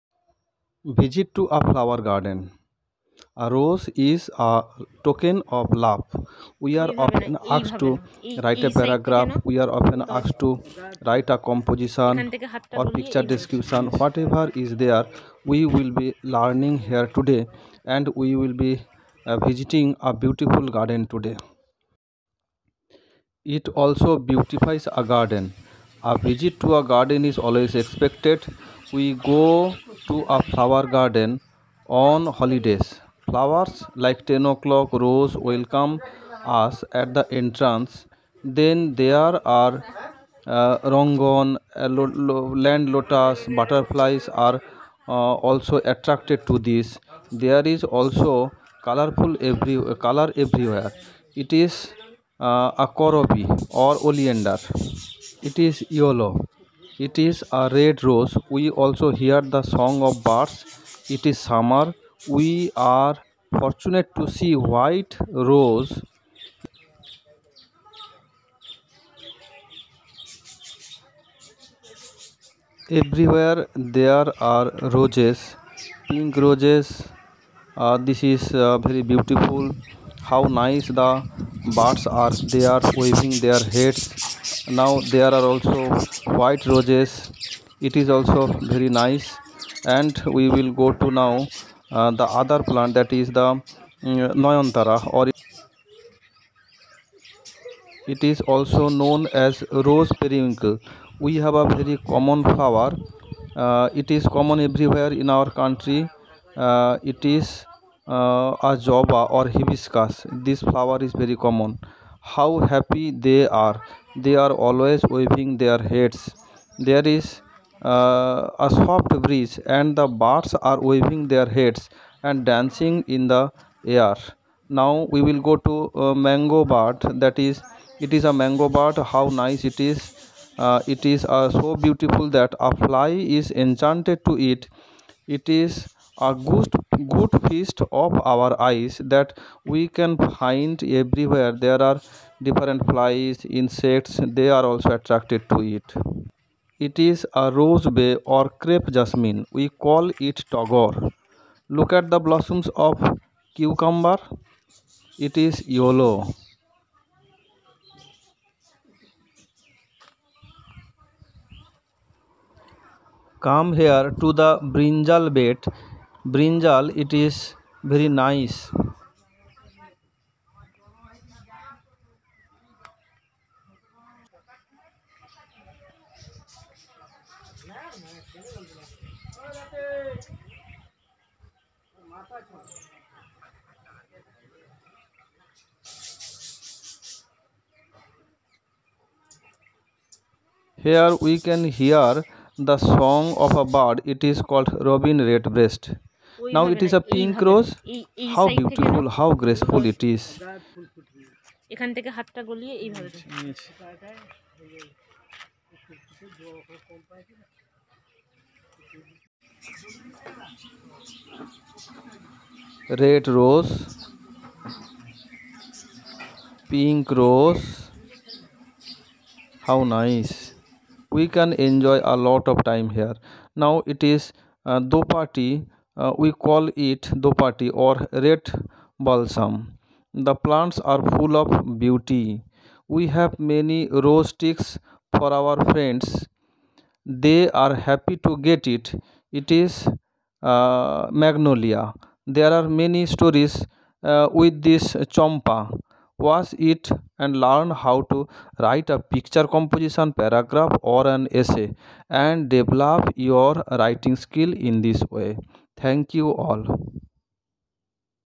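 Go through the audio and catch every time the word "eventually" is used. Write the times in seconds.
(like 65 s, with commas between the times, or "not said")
not said.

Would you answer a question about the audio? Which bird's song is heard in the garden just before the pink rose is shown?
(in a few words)
robin redbreast.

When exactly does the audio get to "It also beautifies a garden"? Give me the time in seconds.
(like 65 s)
23 s.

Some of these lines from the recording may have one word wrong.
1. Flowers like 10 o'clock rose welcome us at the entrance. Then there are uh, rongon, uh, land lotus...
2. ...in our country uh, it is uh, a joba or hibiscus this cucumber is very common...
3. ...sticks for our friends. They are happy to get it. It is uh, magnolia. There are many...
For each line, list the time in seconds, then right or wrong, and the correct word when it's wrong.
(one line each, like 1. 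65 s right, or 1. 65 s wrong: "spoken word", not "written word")
1. 33 s right
2. 105 s wrong: "flower", not "cucumber"
3. 234 s right.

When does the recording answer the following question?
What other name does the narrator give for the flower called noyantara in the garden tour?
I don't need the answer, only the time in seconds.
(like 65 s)
99 s.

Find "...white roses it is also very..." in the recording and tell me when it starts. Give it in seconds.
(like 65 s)
86 s.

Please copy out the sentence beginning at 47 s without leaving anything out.
There is also colorful every color everywhere.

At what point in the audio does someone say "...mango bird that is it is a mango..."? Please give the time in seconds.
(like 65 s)
126 s.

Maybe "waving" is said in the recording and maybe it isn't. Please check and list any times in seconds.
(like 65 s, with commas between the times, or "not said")
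82 s, 115 s, 120 s.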